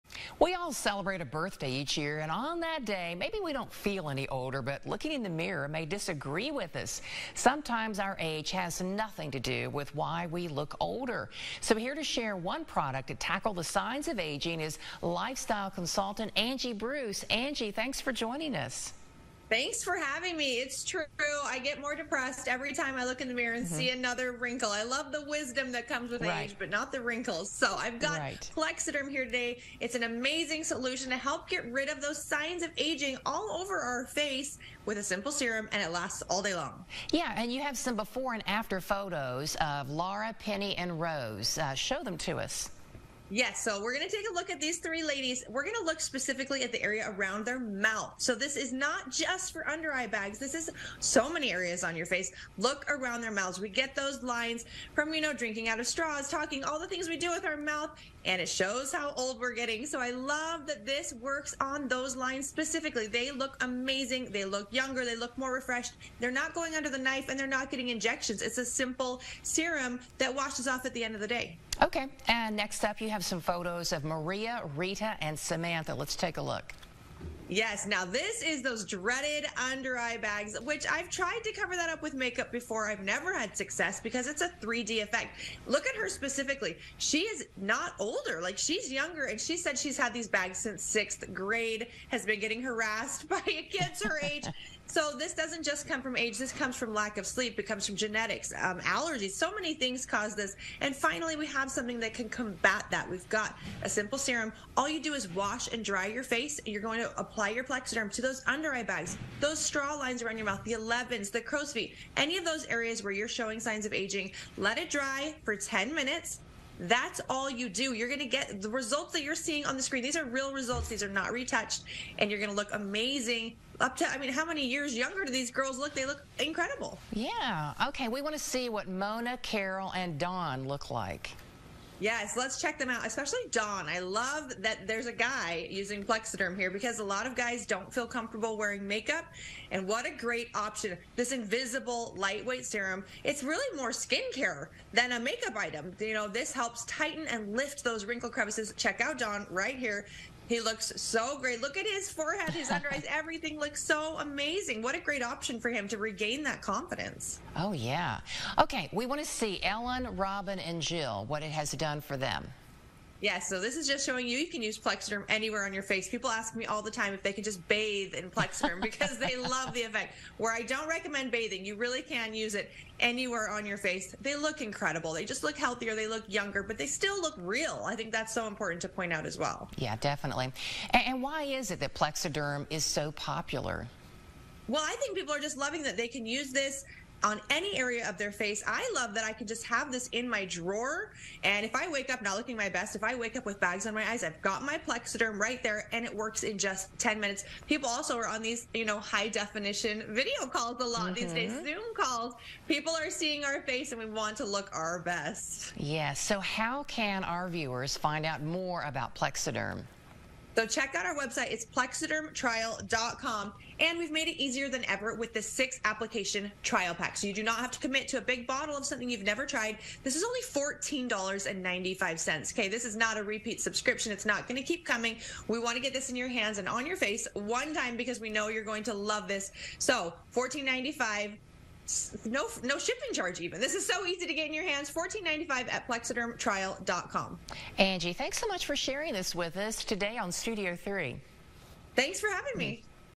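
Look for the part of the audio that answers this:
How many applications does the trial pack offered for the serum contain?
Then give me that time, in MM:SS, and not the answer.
03:35.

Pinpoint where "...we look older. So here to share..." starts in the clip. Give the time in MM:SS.
00:10.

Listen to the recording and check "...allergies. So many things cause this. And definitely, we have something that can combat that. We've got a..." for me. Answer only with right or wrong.
wrong.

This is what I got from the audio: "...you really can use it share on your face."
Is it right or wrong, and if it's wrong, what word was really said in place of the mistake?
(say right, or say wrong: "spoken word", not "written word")
wrong: "anywhere", not "share".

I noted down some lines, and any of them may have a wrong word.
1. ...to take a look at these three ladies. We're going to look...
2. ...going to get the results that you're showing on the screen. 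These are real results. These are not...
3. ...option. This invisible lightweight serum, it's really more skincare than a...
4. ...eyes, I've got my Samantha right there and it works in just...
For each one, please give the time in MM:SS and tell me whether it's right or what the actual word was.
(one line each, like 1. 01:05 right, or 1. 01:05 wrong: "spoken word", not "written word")
1. 00:44 right
2. 01:58 wrong: "seeing", not "showing"
3. 02:20 right
4. 03:14 wrong: "Plexaderm", not "Samantha".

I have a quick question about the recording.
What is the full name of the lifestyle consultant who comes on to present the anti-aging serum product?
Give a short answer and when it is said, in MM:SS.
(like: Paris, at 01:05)
Angie Bruce, at 00:16.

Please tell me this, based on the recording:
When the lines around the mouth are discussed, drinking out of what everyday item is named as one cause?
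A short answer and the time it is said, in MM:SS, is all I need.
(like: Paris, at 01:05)
Straws, at 00:55.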